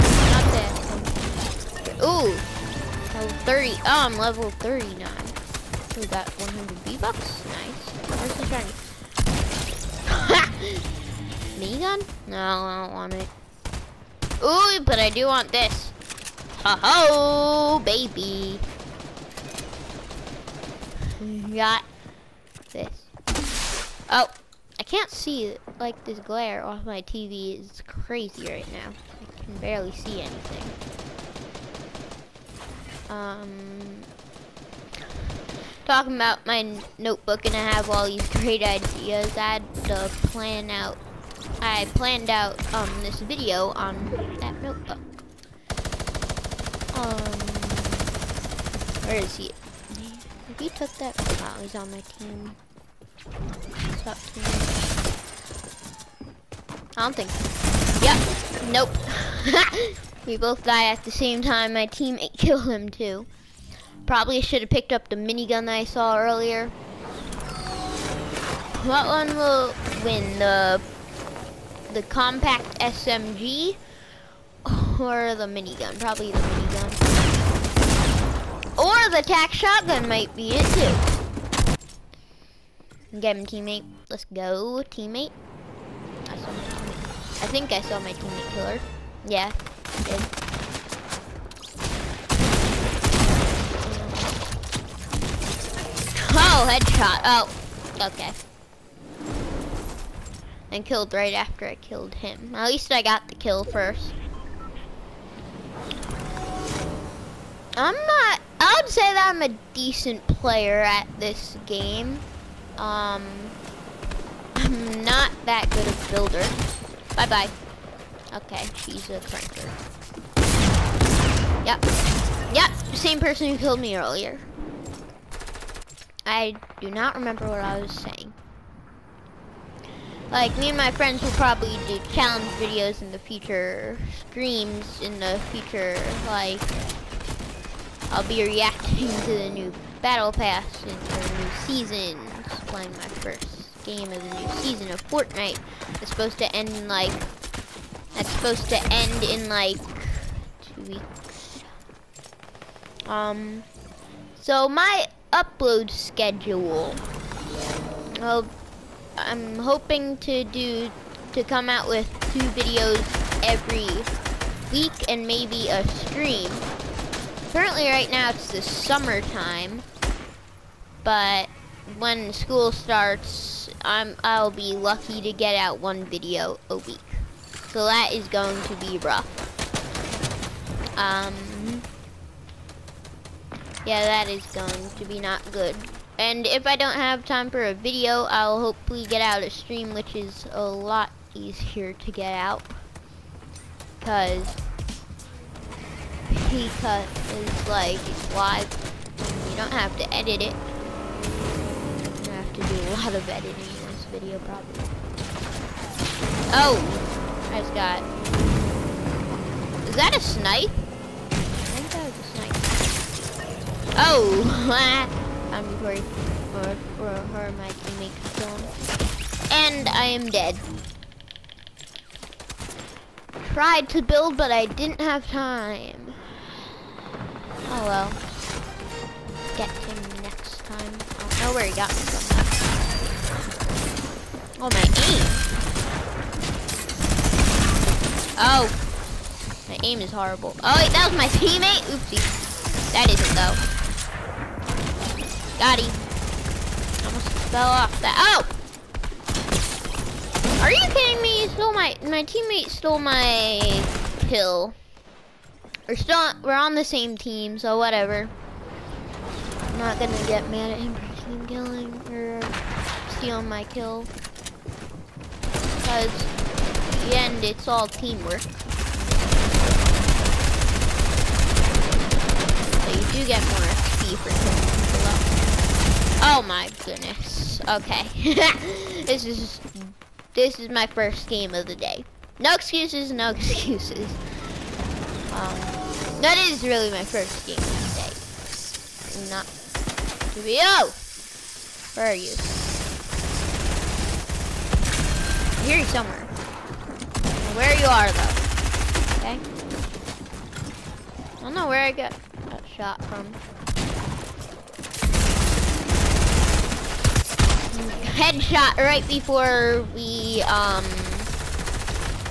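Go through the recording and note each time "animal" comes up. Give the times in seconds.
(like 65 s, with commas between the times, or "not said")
not said.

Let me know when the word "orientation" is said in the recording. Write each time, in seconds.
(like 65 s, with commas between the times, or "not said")
not said.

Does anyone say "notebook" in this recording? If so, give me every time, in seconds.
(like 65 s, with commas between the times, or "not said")
36 s, 44 s.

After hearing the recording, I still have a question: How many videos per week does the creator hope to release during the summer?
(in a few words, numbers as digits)
2.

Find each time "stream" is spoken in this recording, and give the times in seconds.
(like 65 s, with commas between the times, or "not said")
134 s, 165 s, 189 s.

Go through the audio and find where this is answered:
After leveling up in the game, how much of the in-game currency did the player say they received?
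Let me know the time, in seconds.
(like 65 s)
6 s.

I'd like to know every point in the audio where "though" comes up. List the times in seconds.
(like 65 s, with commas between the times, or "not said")
243 s, 298 s.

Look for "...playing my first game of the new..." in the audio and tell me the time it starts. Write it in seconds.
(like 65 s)
142 s.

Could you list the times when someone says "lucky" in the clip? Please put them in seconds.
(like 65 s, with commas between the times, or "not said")
174 s.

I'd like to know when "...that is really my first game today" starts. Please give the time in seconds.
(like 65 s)
286 s.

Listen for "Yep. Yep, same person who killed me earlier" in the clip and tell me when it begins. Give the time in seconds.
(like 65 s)
121 s.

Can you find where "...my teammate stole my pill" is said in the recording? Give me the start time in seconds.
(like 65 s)
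252 s.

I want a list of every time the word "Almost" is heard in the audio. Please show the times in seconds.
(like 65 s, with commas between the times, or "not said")
247 s.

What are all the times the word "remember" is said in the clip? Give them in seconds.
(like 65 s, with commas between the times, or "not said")
127 s.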